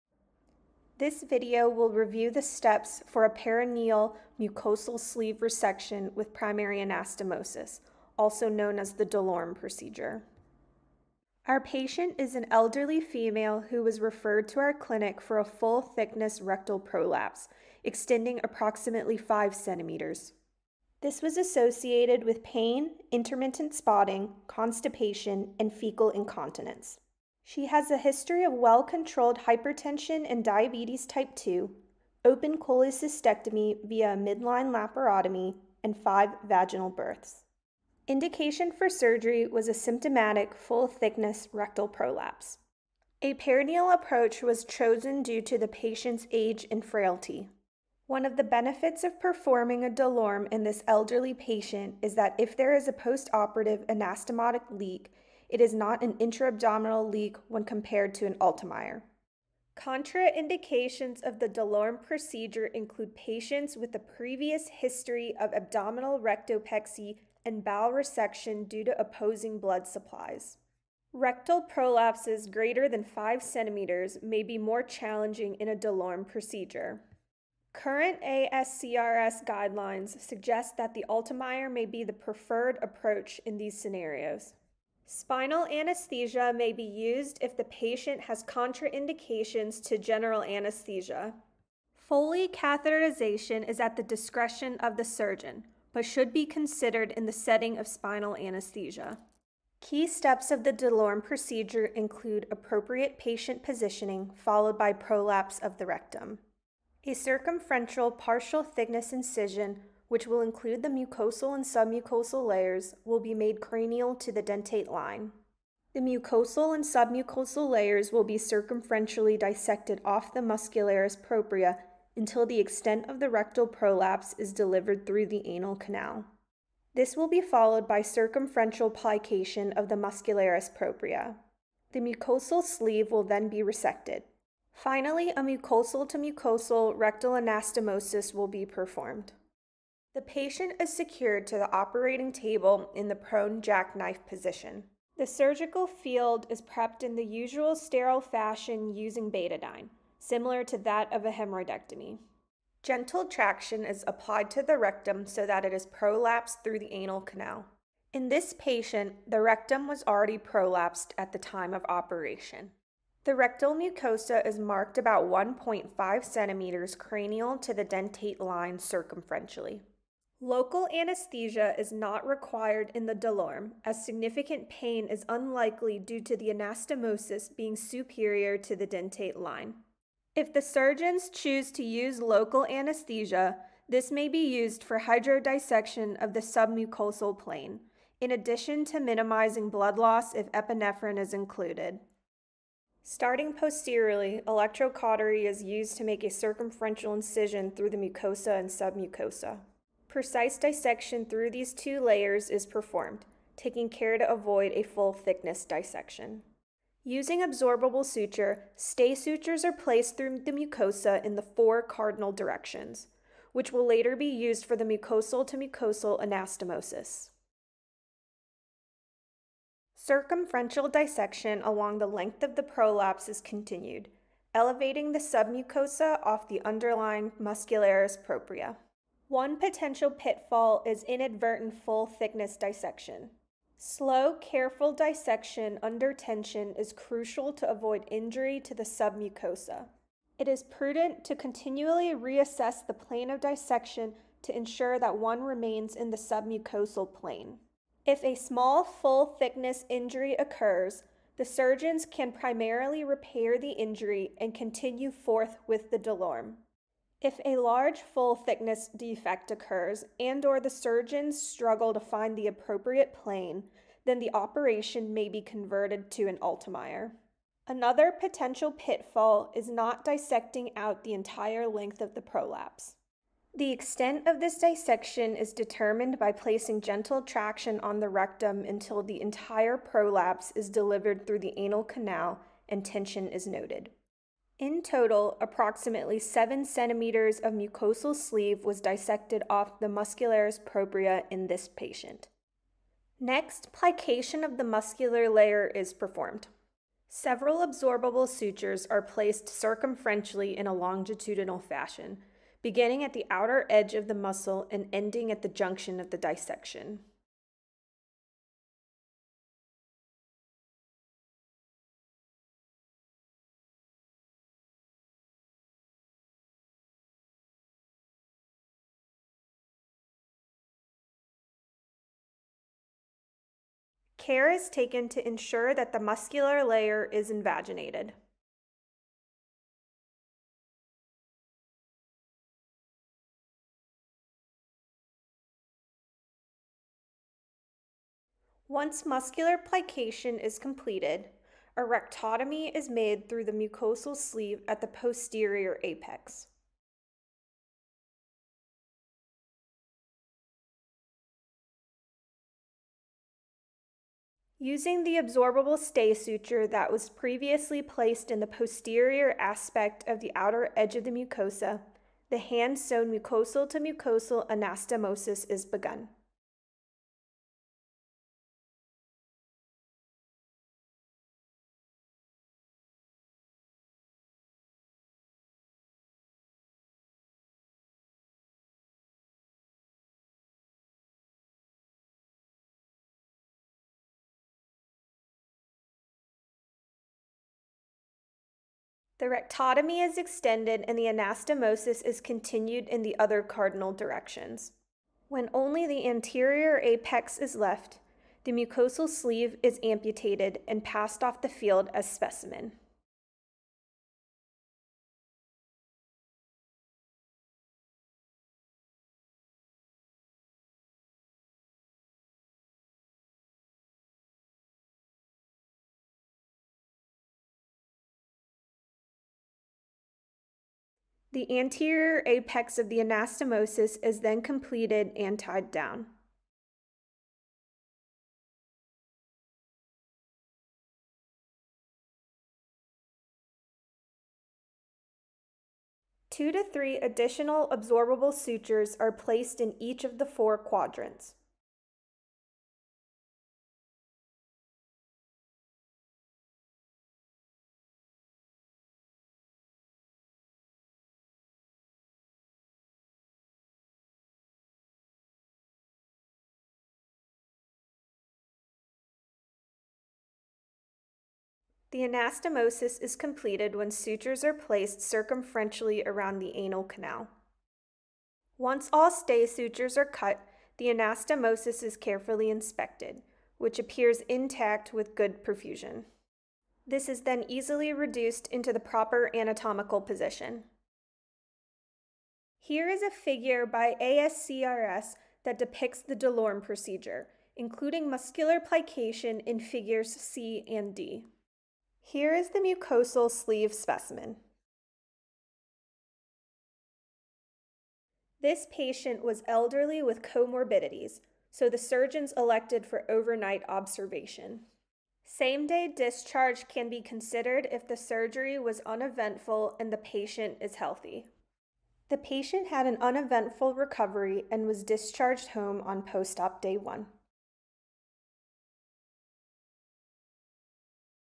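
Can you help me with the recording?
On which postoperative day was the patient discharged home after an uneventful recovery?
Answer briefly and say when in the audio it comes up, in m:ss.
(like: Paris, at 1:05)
day 1, at 8:36.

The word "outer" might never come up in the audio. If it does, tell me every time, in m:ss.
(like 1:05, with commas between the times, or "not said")
5:03, 6:00.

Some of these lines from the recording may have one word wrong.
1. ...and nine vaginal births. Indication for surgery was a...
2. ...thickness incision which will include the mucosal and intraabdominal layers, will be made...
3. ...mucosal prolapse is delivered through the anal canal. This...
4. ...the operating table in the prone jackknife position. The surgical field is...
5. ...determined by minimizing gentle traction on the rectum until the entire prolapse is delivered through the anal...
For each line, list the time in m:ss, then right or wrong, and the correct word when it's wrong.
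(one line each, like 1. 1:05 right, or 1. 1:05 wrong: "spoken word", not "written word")
1. 0:35 wrong: "five", not "nine"
2. 1:48 wrong: "submucosal", not "intraabdominal"
3. 2:03 wrong: "rectal", not "mucosal"
4. 2:21 right
5. 4:35 wrong: "placing", not "minimizing".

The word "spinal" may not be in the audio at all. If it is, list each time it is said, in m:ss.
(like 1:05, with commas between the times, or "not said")
1:25, 1:37.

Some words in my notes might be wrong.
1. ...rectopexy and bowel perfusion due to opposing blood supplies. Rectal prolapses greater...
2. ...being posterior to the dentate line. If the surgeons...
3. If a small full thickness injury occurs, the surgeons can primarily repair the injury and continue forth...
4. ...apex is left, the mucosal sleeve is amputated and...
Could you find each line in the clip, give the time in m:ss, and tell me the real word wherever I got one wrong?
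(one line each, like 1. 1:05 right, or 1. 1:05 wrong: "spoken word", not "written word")
1. 1:06 wrong: "resection", not "perfusion"
2. 2:57 wrong: "superior", not "posterior"
3. 4:08 right
4. 6:36 right.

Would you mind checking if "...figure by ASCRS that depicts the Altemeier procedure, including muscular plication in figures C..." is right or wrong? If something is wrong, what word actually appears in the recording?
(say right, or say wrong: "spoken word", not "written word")
wrong: "DeLorme", not "Altemeier".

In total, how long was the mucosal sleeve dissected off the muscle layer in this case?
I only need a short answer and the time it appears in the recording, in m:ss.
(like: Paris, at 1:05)
7 centimeters, at 4:45.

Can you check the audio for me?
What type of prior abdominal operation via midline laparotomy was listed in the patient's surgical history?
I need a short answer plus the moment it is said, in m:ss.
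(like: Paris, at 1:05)
open cholecystectomy, at 0:32.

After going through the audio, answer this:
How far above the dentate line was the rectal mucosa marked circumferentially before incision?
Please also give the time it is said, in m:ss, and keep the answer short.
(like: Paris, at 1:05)
1.5 centimeters, at 2:45.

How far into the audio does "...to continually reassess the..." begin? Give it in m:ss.
4:01.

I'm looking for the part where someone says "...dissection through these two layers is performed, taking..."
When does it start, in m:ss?
3:20.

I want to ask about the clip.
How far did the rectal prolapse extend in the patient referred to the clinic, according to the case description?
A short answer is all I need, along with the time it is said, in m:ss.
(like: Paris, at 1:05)
5 centimeters, at 0:18.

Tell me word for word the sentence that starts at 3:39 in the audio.
Circumferential dissection along the length of the prolapse is continued, elevating the submucosa off the underlying muscularis propria.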